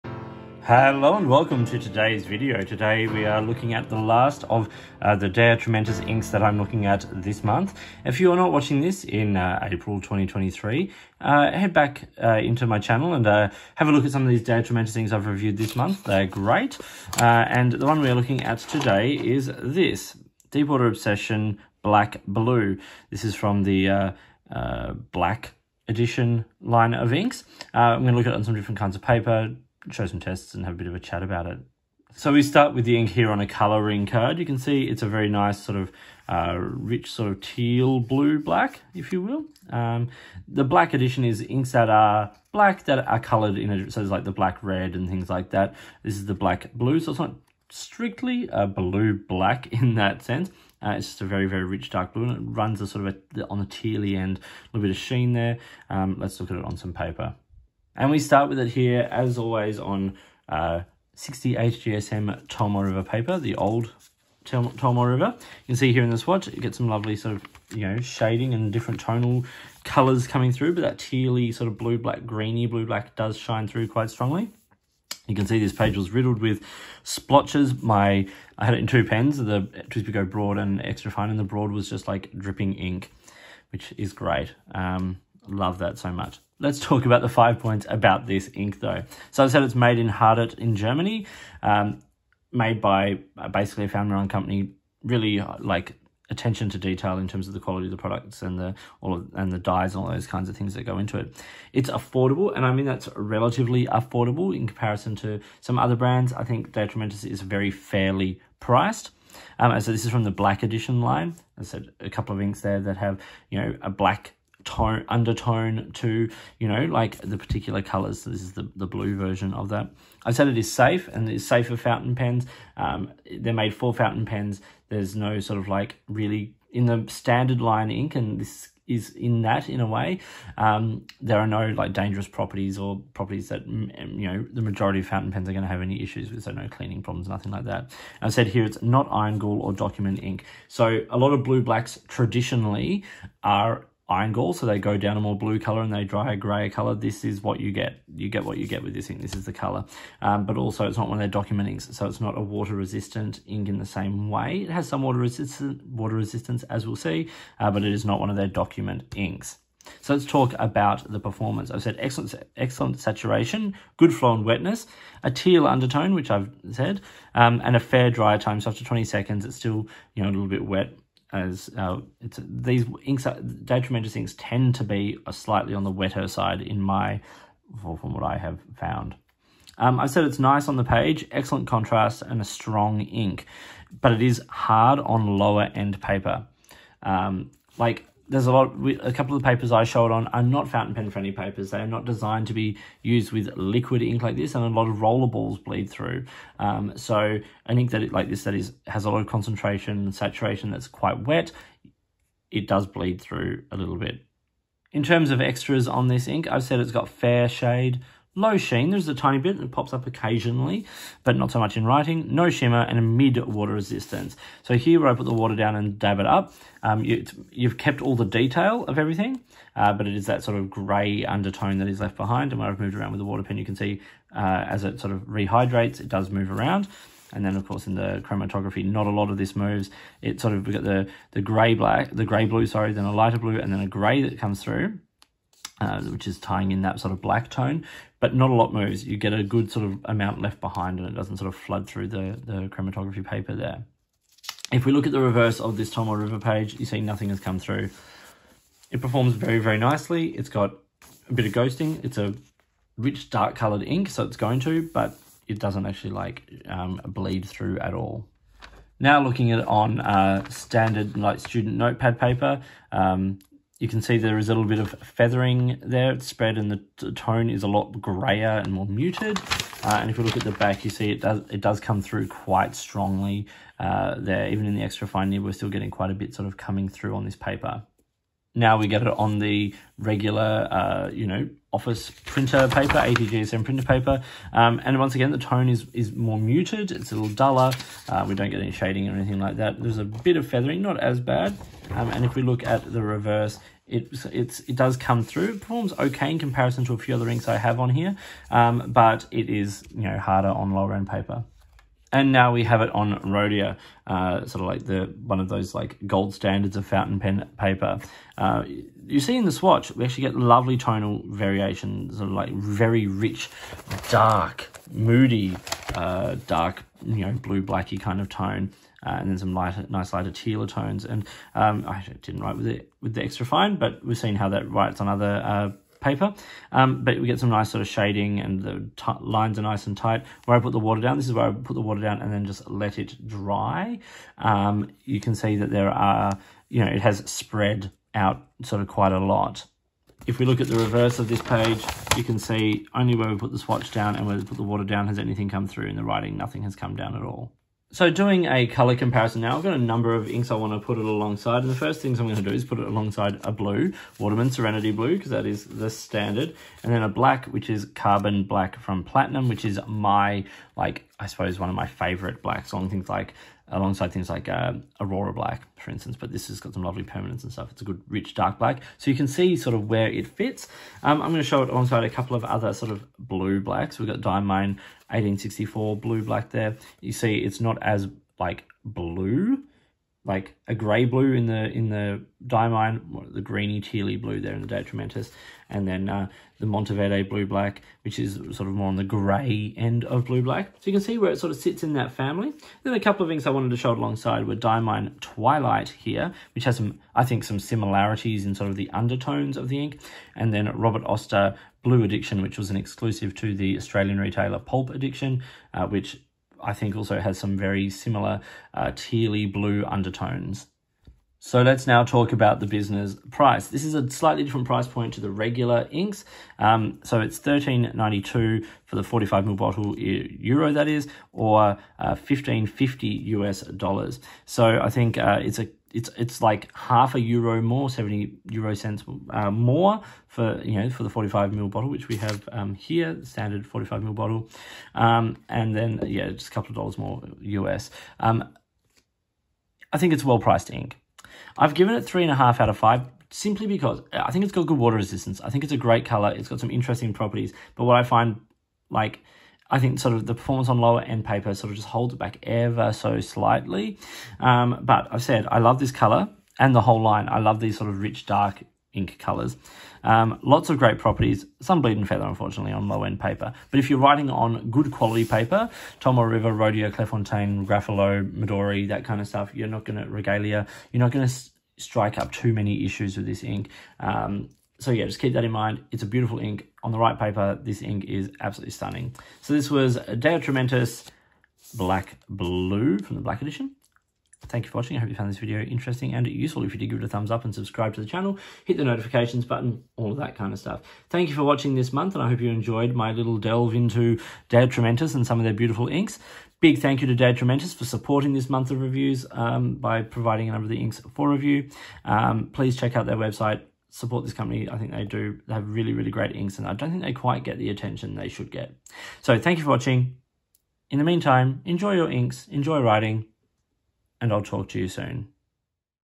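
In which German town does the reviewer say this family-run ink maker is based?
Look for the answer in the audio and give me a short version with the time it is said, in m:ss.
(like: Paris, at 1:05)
Hardet, at 1:30.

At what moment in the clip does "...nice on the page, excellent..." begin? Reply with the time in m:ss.
3:00.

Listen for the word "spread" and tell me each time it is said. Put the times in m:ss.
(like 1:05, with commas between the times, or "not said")
4:26, 5:37.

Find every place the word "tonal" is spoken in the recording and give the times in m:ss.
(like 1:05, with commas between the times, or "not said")
1:08, 5:10.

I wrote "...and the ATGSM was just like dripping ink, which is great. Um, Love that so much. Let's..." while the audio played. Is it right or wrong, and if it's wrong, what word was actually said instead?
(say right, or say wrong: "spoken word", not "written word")
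wrong: "Broad", not "ATGSM".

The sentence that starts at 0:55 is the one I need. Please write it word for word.
Um, let's look at it on some paper.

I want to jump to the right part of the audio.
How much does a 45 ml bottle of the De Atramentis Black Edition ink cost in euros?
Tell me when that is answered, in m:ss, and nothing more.
6:57.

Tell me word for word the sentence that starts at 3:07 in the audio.
Um, like there's a lot, a couple of the papers I showed on are not fountain pen friendly papers.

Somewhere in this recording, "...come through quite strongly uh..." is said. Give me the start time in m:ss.
4:31.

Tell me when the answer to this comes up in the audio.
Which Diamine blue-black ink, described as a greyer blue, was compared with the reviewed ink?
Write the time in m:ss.
6:14.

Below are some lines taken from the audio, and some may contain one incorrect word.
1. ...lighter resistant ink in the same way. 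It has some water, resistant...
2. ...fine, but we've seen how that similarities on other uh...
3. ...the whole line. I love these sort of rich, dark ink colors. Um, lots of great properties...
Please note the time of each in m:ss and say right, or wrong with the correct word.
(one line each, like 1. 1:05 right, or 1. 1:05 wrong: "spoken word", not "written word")
1. 2:32 wrong: "water", not "lighter"
2. 5:23 wrong: "writes", not "similarities"
3. 7:36 right.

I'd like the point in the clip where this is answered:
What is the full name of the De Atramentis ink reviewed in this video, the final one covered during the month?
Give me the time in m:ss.
0:20.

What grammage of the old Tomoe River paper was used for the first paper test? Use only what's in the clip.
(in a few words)
60 GSM.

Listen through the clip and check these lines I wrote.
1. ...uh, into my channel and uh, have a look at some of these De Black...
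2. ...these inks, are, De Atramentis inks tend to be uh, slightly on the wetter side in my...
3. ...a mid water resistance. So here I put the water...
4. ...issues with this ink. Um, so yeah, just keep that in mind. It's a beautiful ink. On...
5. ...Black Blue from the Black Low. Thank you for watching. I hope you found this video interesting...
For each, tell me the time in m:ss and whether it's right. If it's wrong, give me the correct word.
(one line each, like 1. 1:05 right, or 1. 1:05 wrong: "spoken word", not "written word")
1. 0:12 wrong: "Atramentis", not "Black"
2. 2:52 right
3. 3:32 right
4. 7:52 right
5. 8:01 wrong: "Edition", not "Low".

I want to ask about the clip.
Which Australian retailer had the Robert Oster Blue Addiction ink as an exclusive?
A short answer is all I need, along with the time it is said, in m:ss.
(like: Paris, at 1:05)
Pulp Addiction, at 6:44.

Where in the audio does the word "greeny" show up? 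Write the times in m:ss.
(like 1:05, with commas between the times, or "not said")
1:12, 6:23.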